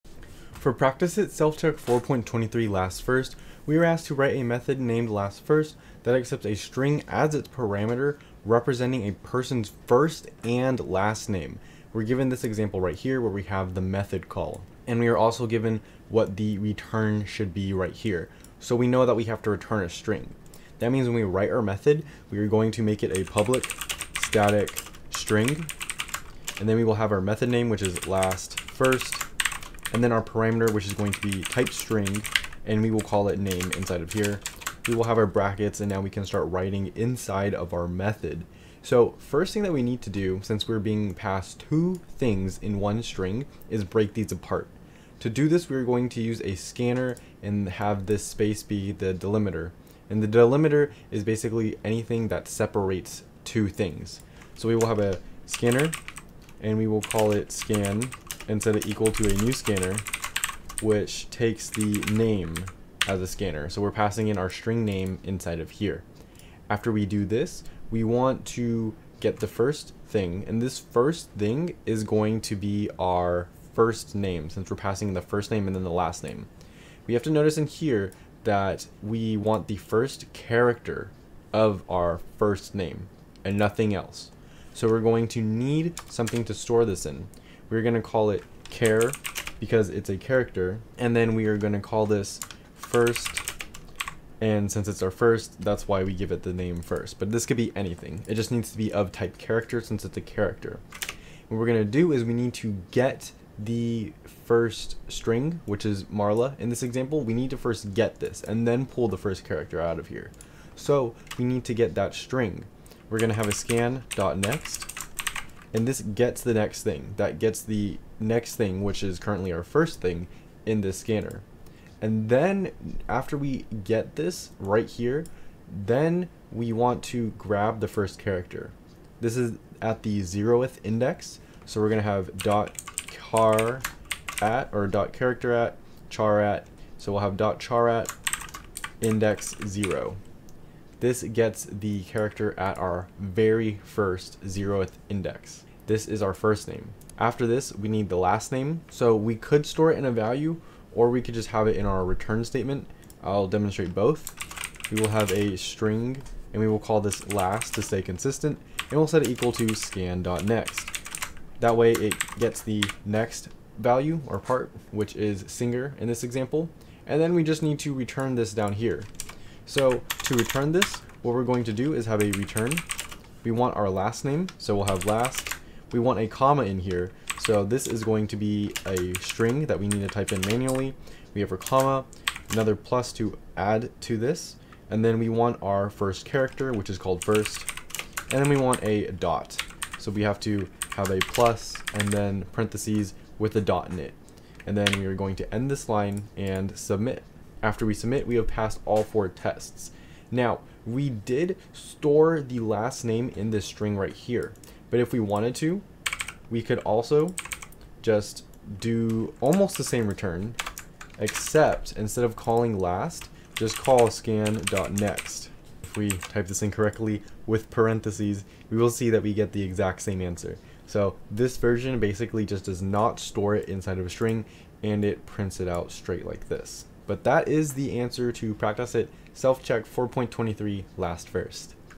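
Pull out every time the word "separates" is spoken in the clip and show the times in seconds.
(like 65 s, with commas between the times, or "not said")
52 s.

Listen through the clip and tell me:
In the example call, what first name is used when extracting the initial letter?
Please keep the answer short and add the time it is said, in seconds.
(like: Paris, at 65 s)
Marla, at 106 s.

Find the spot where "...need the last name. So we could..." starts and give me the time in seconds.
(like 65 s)
147 s.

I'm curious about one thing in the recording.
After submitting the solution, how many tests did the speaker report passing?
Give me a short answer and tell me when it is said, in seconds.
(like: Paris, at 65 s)
4, at 199 s.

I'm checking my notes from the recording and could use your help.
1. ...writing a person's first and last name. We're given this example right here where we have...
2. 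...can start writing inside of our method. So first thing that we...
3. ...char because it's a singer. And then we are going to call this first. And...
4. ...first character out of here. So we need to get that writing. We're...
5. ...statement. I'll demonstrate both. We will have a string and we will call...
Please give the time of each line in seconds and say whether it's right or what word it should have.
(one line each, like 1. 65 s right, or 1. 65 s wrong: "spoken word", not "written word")
1. 8 s wrong: "representing", not "writing"
2. 36 s right
3. 88 s wrong: "character", not "singer"
4. 109 s wrong: "string", not "writing"
5. 152 s right.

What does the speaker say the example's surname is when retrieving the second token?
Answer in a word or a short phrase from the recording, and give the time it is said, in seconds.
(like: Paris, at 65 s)
Singer, at 165 s.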